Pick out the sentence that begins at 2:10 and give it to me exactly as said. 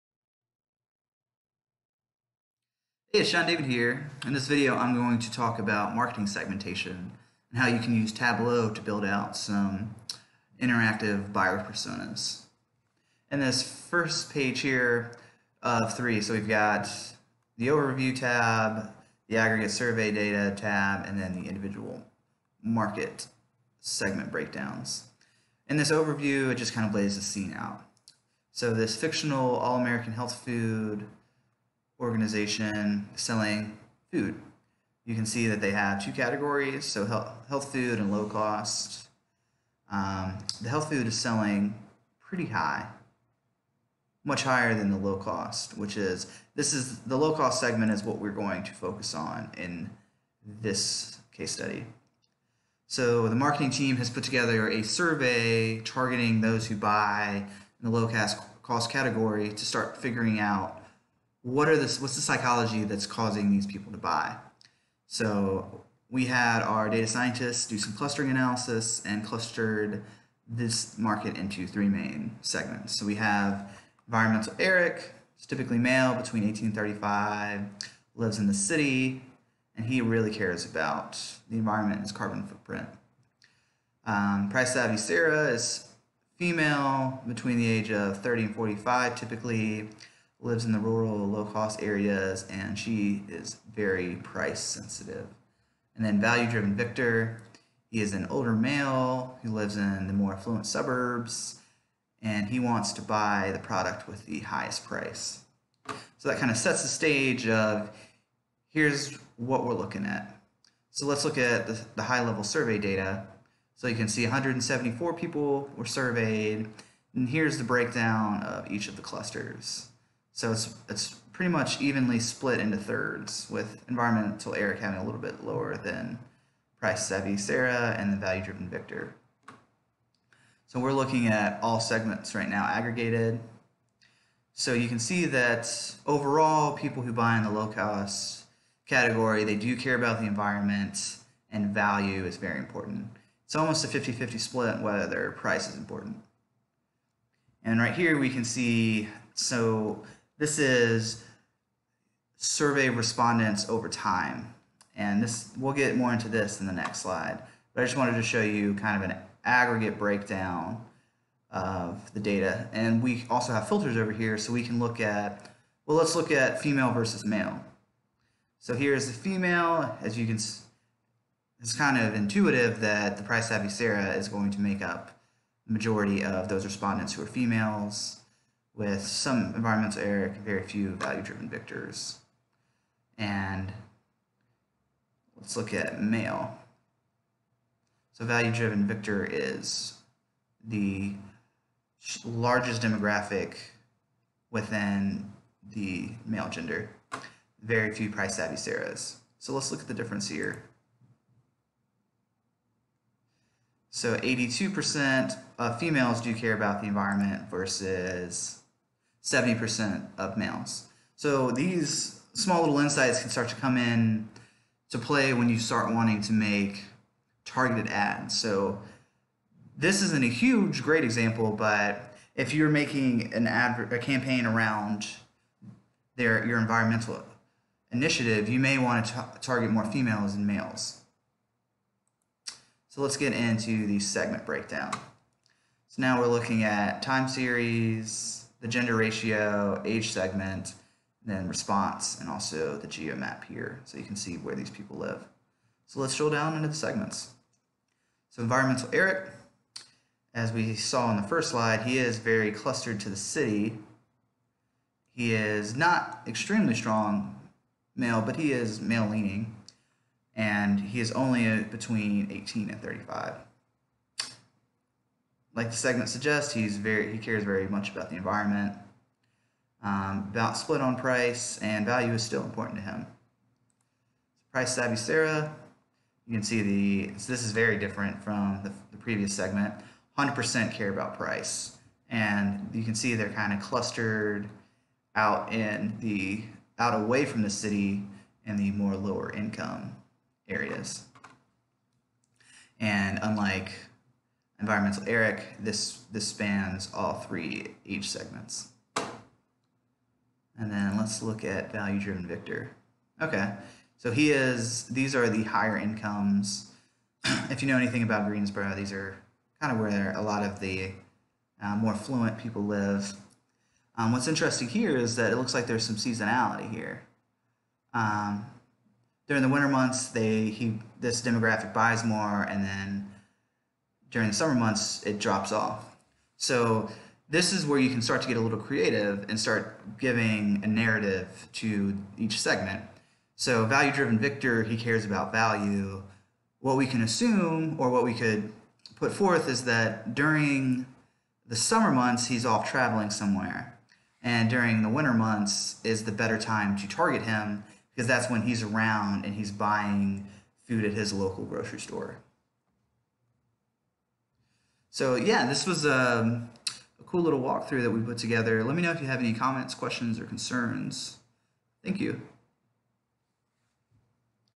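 So we're looking at all segments right now aggregated.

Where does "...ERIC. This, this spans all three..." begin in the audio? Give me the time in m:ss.
4:55.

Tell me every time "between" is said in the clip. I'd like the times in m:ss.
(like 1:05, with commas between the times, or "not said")
1:16, 1:27, 4:21.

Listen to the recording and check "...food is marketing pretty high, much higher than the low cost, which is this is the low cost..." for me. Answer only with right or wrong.
wrong.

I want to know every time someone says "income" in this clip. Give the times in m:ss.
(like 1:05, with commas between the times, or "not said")
4:49, 5:05.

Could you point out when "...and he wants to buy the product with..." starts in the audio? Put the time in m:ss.
1:42.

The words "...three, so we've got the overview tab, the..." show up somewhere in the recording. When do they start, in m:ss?
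0:15.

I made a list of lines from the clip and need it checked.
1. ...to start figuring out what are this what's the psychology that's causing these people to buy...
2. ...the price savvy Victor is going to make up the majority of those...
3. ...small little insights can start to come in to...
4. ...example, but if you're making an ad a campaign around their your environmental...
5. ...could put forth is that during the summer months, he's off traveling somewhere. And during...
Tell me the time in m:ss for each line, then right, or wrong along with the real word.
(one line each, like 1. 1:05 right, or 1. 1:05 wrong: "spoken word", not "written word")
1. 0:59 right
2. 2:53 wrong: "Sarah", not "Victor"
3. 3:32 right
4. 3:41 right
5. 5:38 right.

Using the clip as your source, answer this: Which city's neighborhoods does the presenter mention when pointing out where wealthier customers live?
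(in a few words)
Greensboro.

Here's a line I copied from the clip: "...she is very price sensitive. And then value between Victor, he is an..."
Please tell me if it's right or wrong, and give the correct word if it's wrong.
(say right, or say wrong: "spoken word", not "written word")
wrong: "driven", not "between".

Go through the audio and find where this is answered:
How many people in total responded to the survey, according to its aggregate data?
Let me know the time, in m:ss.
1:54.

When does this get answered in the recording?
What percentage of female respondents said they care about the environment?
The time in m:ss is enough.
3:24.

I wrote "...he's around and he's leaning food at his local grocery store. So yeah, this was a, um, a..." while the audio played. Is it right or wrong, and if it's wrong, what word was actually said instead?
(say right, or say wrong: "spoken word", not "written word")
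wrong: "buying", not "leaning".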